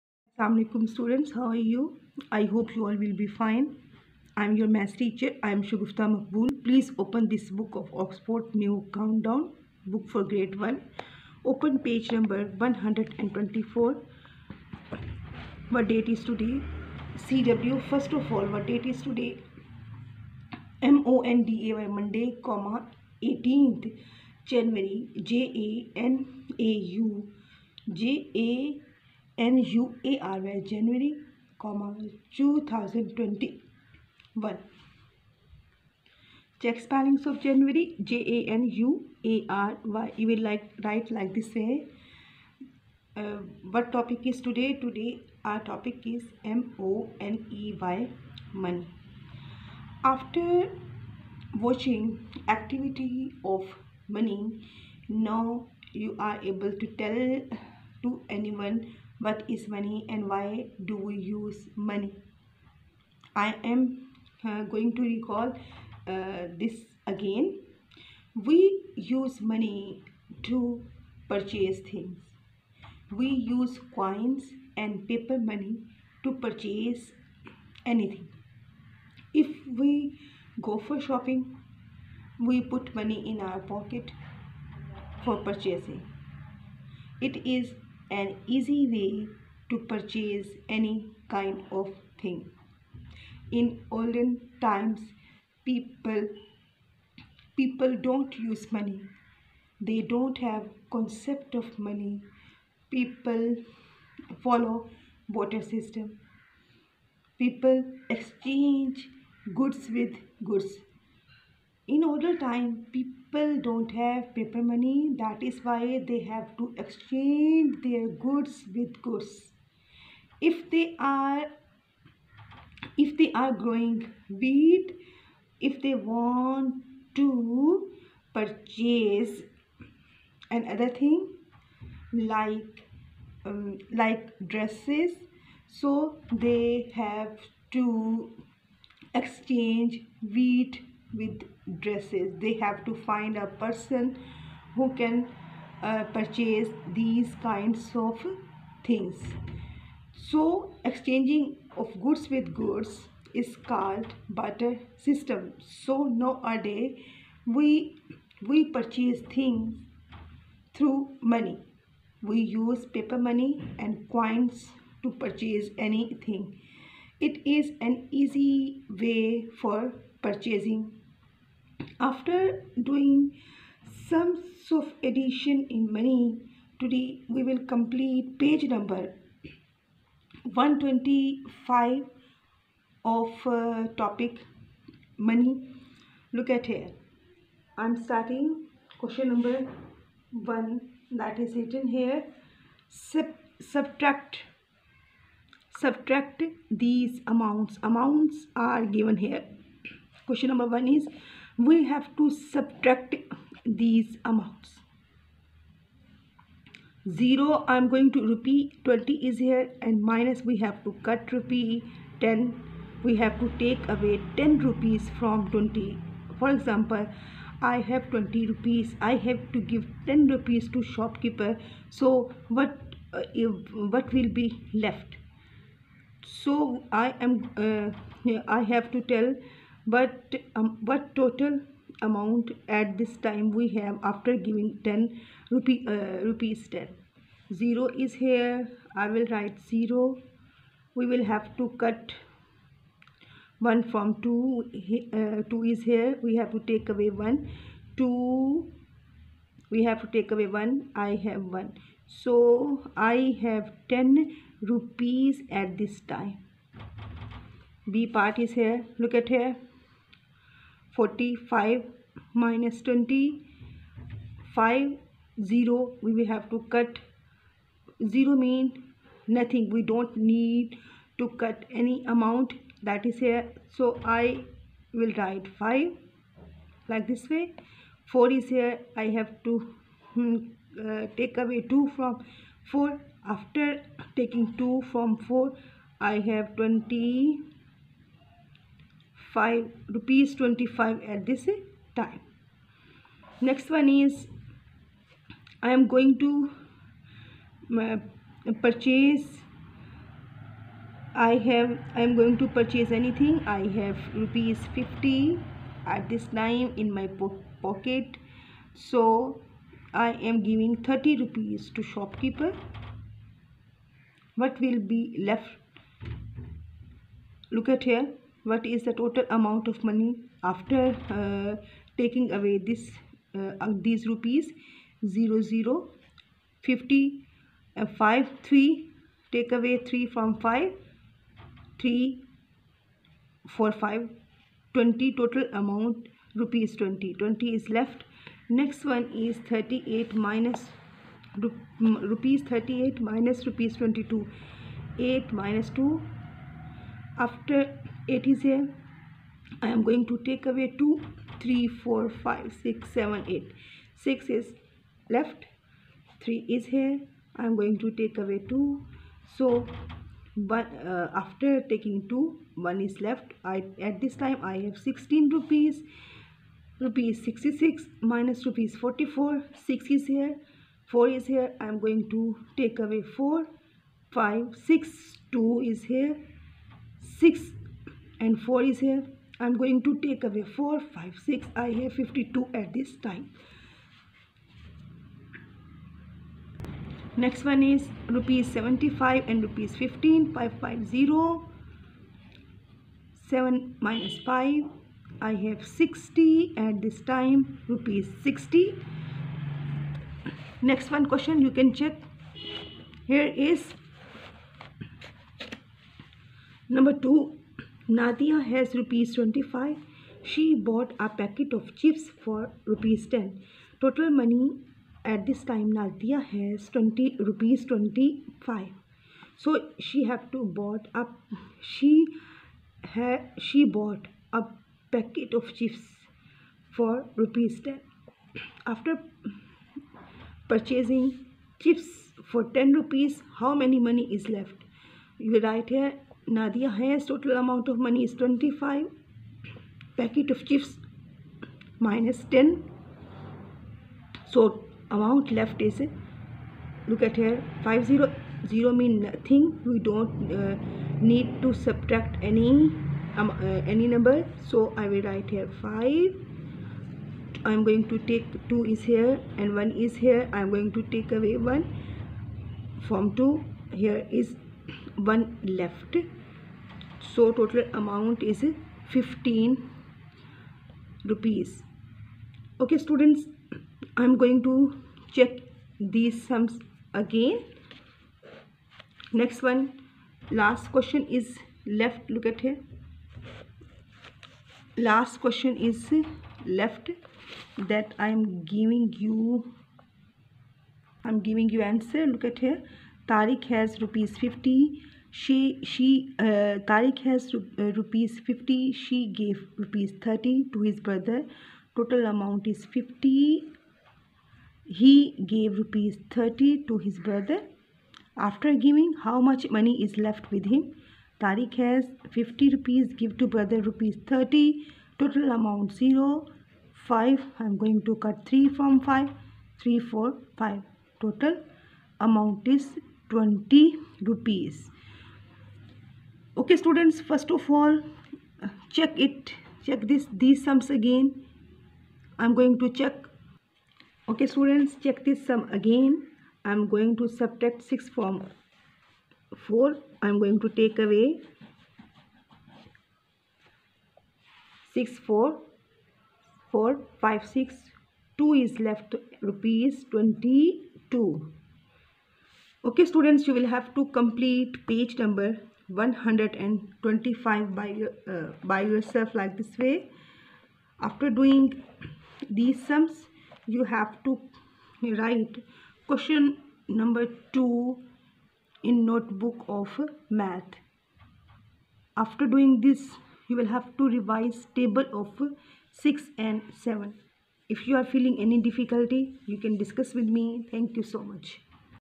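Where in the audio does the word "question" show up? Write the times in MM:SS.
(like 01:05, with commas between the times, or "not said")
03:08, 03:20, 06:41, 08:00, 08:05, 09:25.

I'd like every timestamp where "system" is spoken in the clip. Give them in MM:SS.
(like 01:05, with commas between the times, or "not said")
01:45, 02:34.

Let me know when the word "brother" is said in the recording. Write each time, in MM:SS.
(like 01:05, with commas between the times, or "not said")
08:20, 08:26, 08:33.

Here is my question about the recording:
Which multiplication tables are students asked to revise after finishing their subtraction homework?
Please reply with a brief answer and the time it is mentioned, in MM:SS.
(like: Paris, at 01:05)
6 and 7, at 09:34.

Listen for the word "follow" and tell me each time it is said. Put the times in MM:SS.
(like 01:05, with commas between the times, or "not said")
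01:44.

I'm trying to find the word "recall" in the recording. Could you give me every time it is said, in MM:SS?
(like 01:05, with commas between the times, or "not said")
01:05.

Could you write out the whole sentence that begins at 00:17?
CW, first of all, what date is today?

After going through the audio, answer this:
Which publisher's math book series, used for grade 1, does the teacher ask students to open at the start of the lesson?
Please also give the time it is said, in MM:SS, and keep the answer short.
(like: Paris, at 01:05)
Oxford New Countdown, at 00:08.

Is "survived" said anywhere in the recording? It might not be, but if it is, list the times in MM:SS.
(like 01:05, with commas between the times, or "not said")
not said.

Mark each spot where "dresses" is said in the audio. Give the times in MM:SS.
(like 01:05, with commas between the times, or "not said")
02:14, 02:21.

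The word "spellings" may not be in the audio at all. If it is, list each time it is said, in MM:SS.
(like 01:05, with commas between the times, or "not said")
00:36.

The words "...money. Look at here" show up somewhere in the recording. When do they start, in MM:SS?
03:05.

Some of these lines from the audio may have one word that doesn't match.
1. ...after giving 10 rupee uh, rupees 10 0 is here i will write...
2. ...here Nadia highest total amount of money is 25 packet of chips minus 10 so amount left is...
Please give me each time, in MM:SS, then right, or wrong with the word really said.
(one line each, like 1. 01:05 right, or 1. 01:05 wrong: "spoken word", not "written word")
1. 03:54 right
2. 07:15 right.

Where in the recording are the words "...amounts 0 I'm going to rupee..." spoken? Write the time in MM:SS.
03:24.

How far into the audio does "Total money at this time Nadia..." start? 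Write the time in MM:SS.
06:53.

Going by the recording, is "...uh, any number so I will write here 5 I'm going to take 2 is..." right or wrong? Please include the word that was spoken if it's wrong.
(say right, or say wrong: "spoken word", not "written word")
right.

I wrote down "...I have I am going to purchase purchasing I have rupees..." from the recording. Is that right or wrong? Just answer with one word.
wrong.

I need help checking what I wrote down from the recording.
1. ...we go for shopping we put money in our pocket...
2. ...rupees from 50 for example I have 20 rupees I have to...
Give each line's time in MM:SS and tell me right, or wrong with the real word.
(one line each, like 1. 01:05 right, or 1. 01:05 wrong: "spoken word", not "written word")
1. 01:19 right
2. 03:34 wrong: "20", not "50".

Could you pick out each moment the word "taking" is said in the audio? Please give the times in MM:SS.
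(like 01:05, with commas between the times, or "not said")
04:44, 05:21, 06:01.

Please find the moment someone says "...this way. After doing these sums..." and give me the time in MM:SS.
09:19.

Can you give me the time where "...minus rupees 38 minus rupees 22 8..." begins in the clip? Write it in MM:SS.
05:40.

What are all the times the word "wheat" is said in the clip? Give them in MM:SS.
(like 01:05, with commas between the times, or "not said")
02:04, 02:20.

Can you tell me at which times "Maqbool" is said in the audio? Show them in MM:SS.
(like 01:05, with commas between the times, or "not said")
00:06.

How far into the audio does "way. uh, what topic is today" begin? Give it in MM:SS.
00:41.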